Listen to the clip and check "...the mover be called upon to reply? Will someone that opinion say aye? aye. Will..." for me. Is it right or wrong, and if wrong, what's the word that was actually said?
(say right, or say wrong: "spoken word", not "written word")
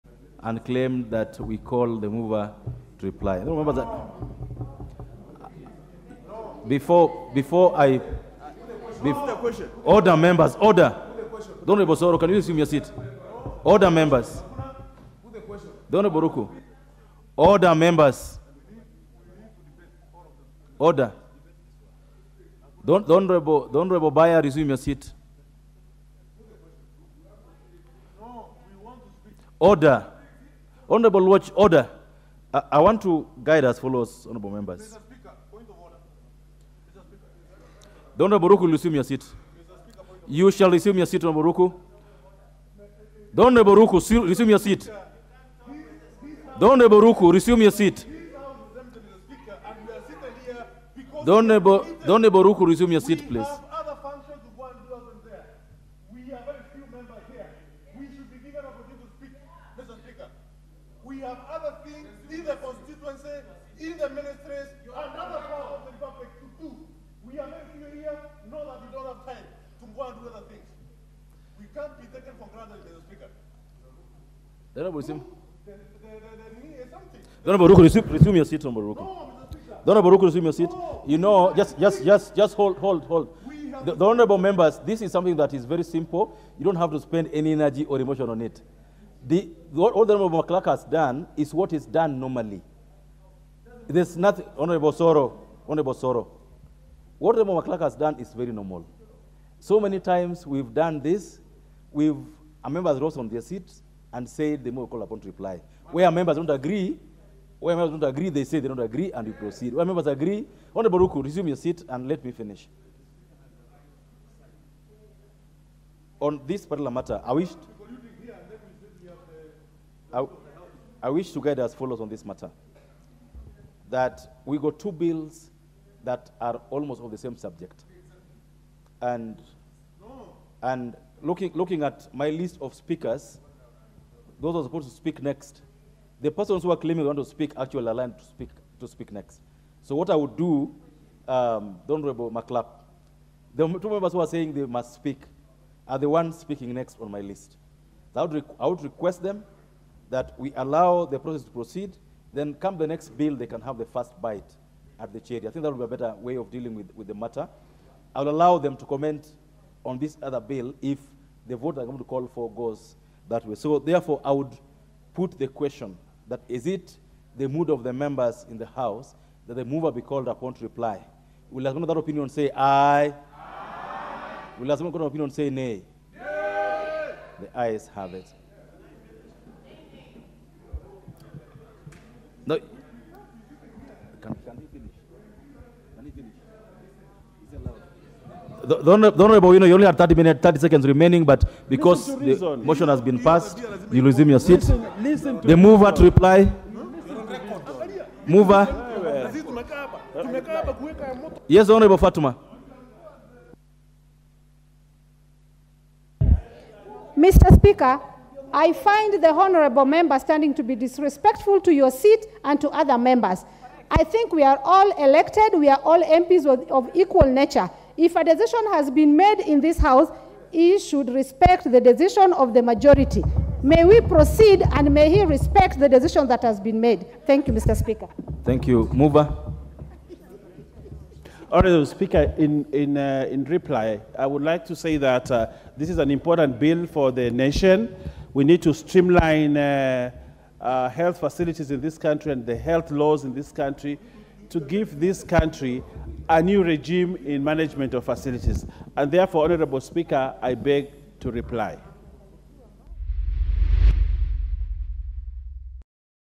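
right.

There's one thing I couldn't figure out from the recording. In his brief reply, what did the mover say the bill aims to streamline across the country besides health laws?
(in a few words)
health facilities.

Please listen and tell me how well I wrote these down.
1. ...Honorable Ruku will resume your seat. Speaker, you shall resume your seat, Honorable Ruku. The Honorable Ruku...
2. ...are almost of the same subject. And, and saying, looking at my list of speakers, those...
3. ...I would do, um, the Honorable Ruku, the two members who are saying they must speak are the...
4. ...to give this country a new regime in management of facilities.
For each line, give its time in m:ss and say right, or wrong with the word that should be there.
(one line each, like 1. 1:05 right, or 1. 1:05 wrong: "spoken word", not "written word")
1. 0:38 right
2. 2:06 wrong: "looking", not "saying"
3. 2:20 wrong: "McLap", not "Ruku"
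4. 4:04 right.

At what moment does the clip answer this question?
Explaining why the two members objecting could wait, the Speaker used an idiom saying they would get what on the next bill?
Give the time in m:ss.
2:33.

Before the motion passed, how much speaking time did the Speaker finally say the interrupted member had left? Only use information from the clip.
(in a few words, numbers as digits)
30 seconds.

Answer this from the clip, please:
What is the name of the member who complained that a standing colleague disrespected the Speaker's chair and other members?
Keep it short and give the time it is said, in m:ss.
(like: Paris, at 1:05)
Honorable Fatuma, at 3:21.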